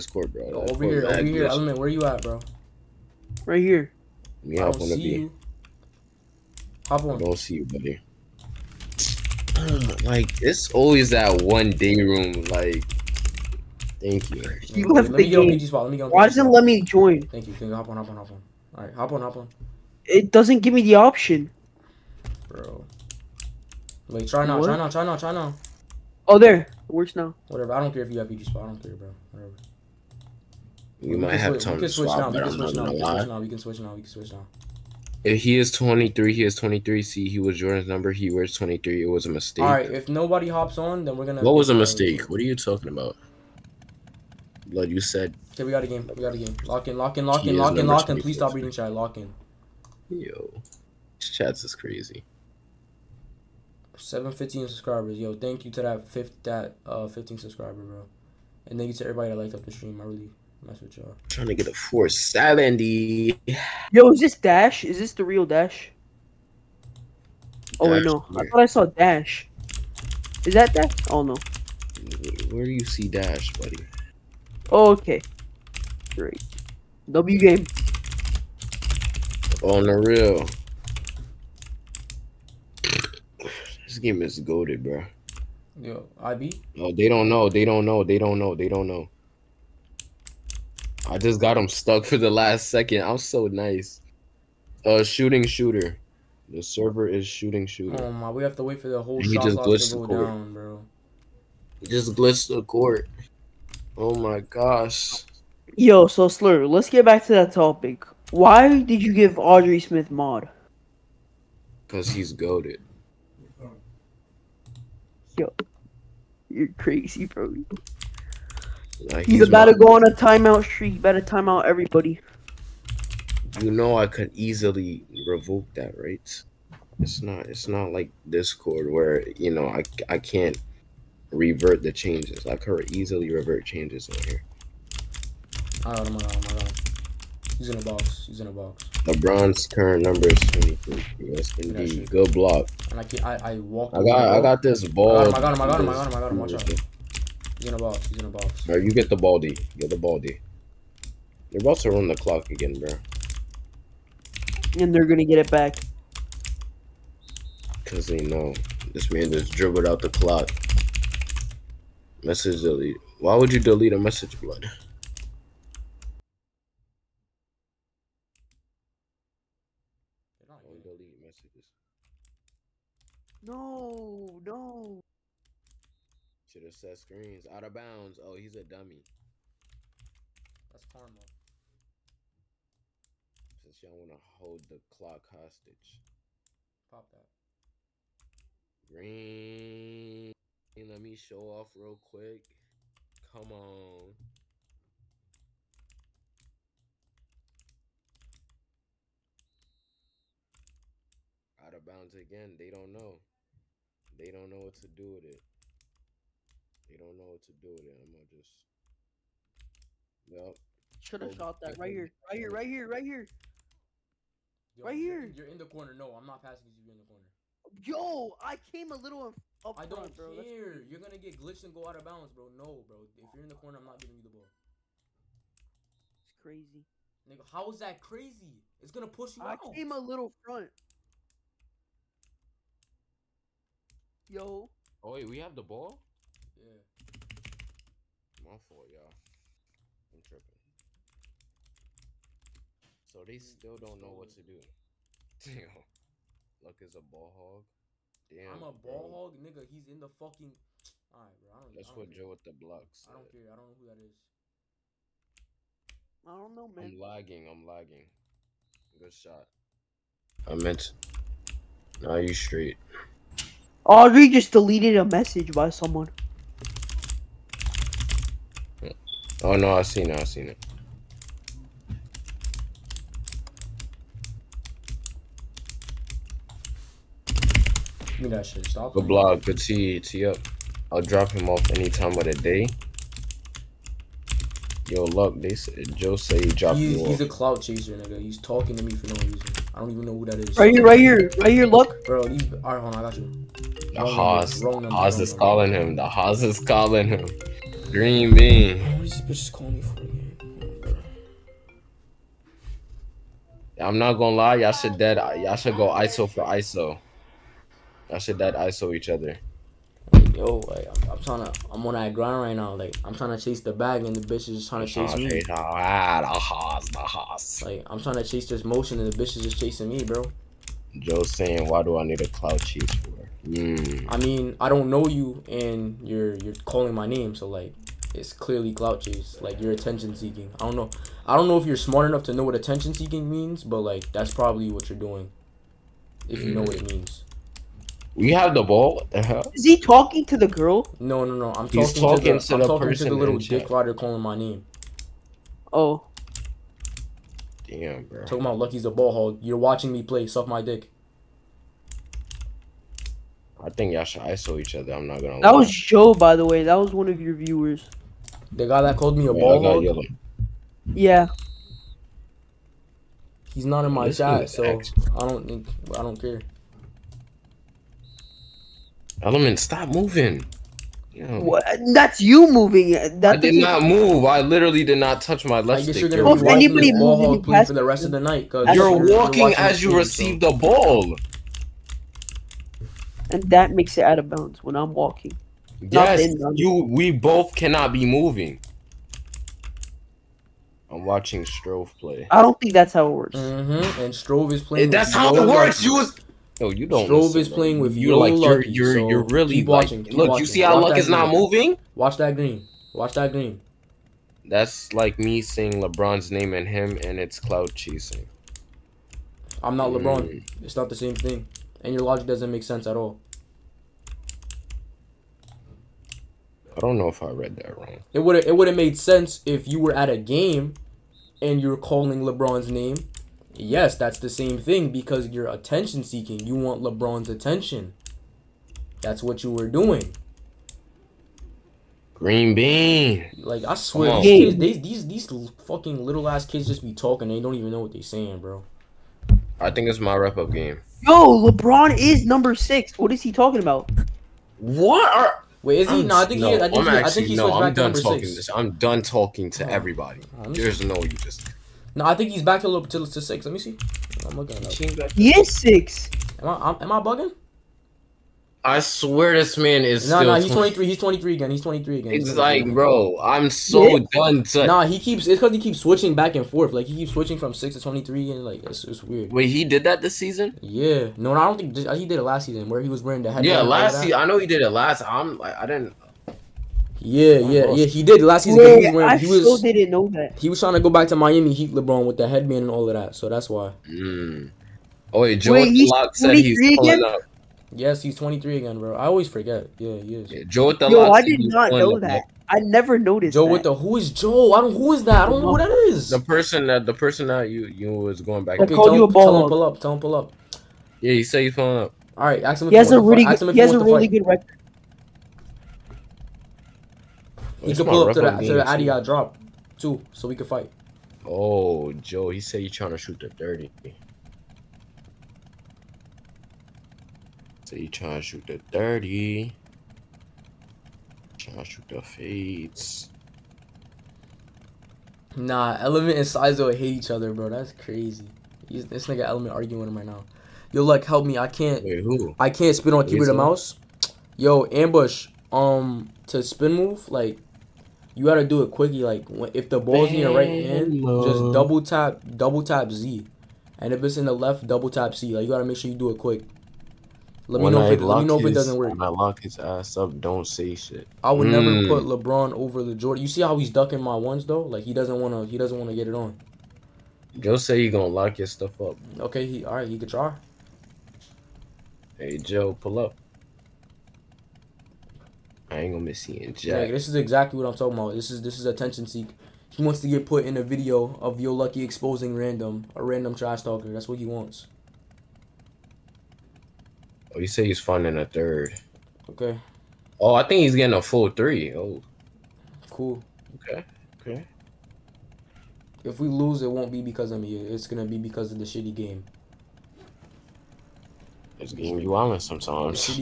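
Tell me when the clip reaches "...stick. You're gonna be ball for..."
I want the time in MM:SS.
06:15.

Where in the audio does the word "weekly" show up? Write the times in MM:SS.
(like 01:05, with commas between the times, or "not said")
not said.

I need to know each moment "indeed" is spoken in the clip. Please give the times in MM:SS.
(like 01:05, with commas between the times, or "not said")
02:21.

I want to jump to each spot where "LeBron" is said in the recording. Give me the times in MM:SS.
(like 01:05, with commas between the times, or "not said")
02:19, 06:45, 06:50, 07:02, 07:06, 07:21, 08:01, 09:12.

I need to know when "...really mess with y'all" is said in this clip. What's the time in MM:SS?
01:00.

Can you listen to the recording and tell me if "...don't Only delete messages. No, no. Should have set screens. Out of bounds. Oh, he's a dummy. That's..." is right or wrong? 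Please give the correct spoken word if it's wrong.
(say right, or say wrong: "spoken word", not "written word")
right.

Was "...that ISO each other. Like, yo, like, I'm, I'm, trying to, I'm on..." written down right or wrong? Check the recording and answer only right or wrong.
right.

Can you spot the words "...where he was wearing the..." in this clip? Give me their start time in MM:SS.
07:52.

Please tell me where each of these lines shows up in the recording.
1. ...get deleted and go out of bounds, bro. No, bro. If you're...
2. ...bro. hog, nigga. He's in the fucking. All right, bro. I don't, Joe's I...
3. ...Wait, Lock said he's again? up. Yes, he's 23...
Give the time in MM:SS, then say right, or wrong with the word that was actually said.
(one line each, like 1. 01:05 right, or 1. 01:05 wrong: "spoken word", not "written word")
1. 03:41 wrong: "glitched", not "deleted"
2. 04:09 wrong: "That", not "Joe"
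3. 08:05 right.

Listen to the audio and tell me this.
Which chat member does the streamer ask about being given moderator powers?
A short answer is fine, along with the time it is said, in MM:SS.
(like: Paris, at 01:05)
Audrey Smith, at 01:49.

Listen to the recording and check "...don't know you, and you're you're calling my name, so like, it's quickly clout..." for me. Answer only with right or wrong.
wrong.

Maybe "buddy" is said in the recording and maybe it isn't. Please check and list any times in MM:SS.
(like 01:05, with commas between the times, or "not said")
00:07, 01:13.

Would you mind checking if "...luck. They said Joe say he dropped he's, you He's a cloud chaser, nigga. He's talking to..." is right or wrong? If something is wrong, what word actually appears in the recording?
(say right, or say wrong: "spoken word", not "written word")
right.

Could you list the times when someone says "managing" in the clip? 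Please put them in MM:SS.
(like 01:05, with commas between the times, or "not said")
not said.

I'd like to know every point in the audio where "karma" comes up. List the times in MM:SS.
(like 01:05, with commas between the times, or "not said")
03:00.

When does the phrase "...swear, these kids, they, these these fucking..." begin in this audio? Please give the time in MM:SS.
07:13.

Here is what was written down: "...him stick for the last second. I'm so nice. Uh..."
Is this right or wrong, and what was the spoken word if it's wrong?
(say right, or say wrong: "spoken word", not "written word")
wrong: "stuck", not "stick".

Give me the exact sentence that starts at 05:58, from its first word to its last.
The guy that called me a Wait, ball hog.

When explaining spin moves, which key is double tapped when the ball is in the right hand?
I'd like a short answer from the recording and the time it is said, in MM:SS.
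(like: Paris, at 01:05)
Z, at 09:02.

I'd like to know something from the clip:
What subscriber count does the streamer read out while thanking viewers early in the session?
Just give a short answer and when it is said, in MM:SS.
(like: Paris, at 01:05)
715, at 00:53.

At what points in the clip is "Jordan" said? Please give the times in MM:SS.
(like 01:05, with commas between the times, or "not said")
00:37, 09:12.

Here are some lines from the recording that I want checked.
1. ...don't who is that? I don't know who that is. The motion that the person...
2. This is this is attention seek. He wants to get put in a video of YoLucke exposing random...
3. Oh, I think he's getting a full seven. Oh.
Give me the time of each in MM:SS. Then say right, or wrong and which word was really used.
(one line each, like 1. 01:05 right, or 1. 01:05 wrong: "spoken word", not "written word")
1. 08:14 wrong: "person", not "motion"
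2. 09:28 right
3. 09:40 wrong: "three", not "seven".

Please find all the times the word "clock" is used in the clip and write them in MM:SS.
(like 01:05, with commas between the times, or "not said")
02:32, 02:40, 03:04.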